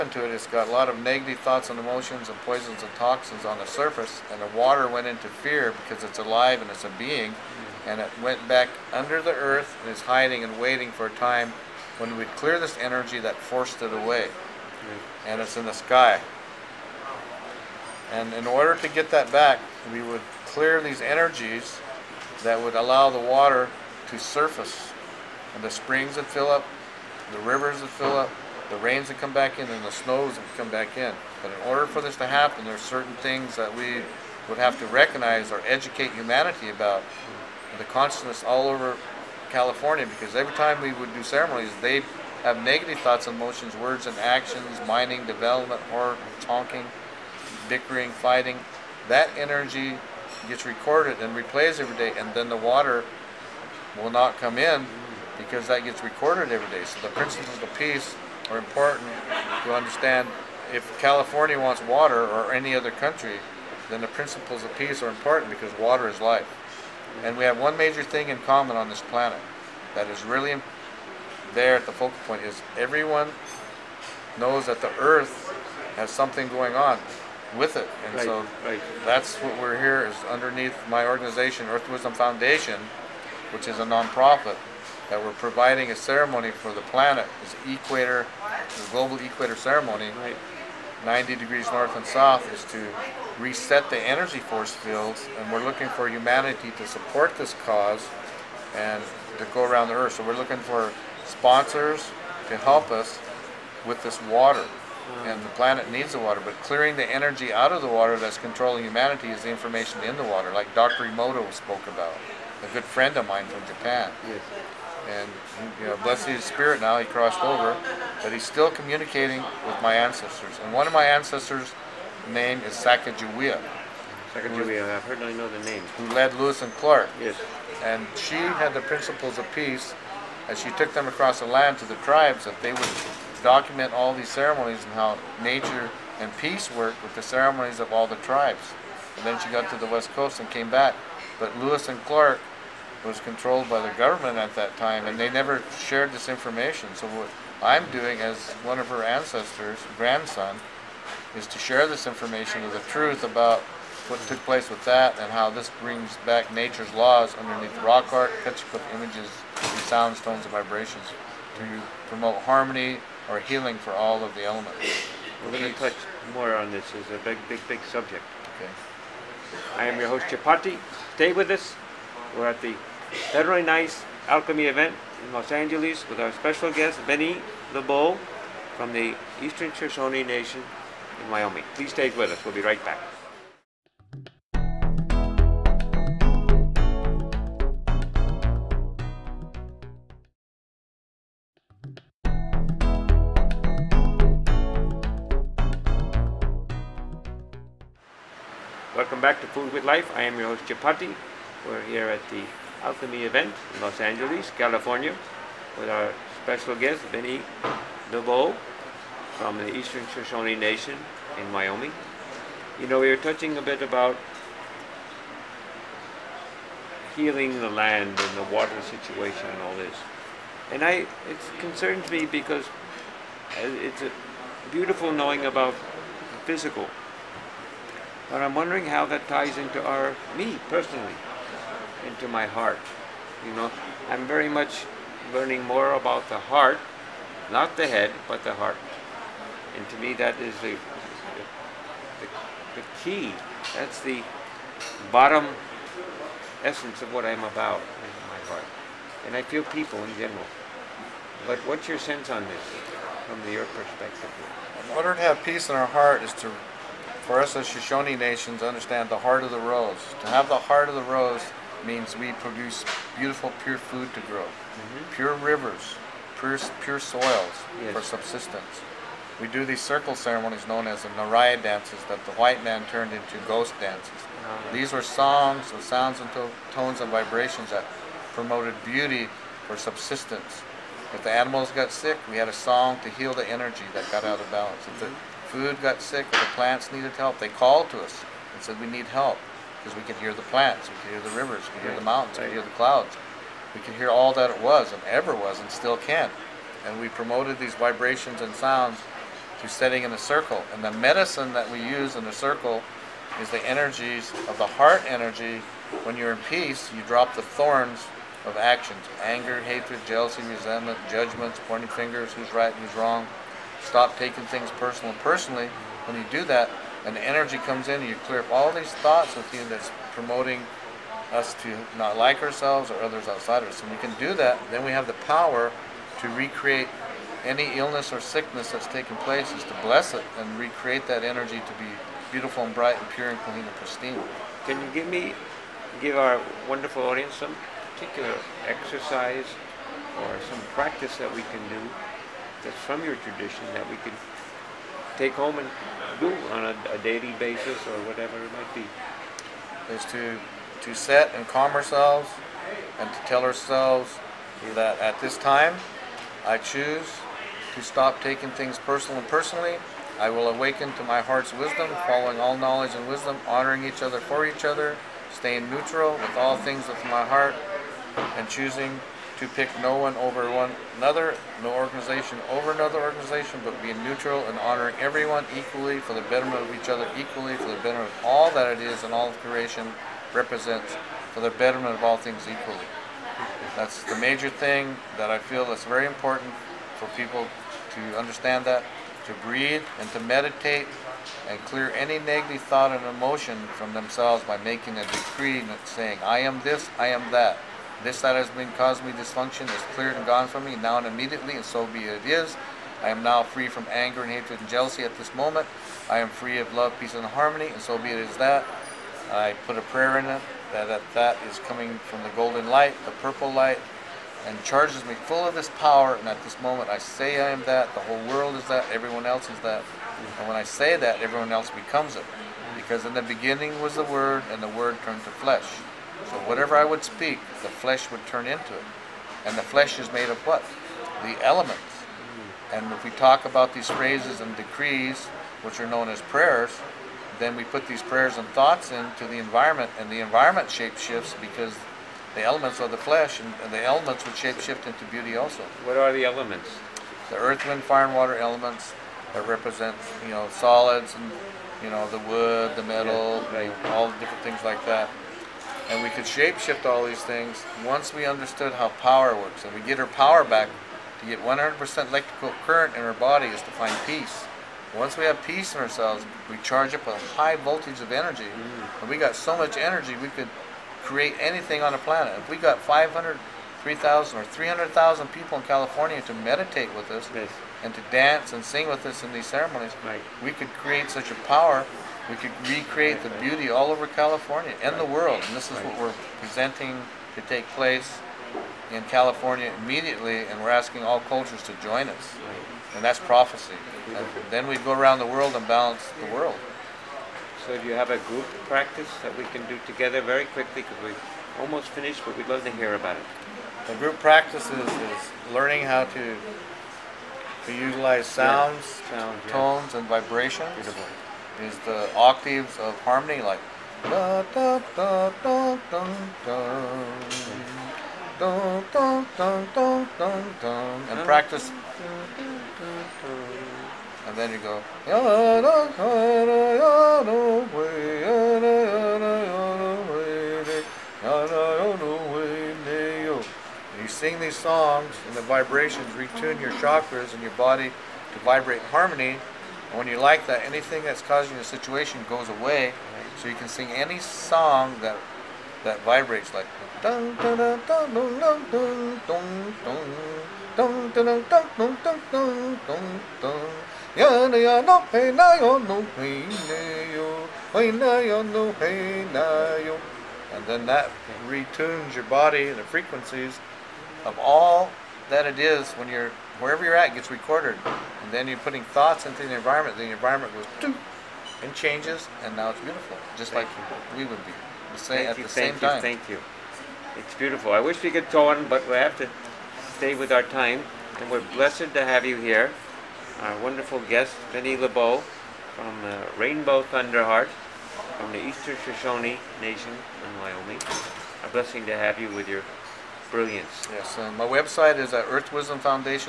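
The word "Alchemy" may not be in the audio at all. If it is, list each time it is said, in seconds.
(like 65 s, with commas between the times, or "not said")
174 s, 202 s.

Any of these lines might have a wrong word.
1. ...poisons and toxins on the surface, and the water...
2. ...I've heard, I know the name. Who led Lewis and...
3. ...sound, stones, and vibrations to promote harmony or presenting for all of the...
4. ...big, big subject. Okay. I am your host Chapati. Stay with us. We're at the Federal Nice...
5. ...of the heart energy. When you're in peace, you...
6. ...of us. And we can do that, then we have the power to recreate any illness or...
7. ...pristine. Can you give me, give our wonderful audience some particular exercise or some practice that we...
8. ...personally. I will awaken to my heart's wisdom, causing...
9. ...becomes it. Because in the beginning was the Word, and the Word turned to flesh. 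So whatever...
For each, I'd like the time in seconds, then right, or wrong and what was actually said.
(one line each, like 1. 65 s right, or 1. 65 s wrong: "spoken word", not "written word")
1. 2 s right
2. 124 s right
3. 159 s wrong: "healing", not "presenting"
4. 167 s right
5. 304 s right
6. 323 s right
7. 333 s right
8. 359 s wrong: "following", not "causing"
9. 421 s right.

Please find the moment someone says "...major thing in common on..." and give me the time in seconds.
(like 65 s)
67 s.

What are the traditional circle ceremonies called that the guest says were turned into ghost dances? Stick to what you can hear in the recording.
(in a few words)
Naraya dances.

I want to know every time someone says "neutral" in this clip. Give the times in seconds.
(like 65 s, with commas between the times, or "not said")
365 s, 374 s.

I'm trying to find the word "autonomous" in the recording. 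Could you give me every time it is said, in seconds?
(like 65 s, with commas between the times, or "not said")
not said.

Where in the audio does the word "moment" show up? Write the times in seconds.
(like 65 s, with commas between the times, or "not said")
405 s, 416 s.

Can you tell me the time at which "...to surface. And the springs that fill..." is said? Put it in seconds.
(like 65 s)
24 s.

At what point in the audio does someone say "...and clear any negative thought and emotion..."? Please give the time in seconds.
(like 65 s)
391 s.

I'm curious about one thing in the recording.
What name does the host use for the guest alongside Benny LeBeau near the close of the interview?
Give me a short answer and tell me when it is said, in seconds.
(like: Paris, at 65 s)
Rainbow Thunderheart, at 586 s.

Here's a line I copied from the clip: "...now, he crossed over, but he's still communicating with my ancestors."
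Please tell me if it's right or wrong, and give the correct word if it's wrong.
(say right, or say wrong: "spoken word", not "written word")
right.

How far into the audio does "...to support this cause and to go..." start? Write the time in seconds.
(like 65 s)
96 s.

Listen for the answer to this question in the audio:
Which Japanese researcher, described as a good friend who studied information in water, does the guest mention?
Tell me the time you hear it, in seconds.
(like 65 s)
110 s.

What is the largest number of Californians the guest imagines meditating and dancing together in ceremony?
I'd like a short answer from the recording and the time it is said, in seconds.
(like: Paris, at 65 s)
300,000, at 474 s.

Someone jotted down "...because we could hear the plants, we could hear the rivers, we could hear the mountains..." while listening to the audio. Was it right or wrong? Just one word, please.
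right.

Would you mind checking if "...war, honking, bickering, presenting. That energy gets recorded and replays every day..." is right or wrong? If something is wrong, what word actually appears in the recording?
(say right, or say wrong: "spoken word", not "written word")
wrong: "fighting", not "presenting".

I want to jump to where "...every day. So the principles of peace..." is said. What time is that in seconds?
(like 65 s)
56 s.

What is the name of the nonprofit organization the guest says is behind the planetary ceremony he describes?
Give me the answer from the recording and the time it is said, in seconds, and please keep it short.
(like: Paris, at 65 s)
Earth Wisdom Foundation, at 81 s.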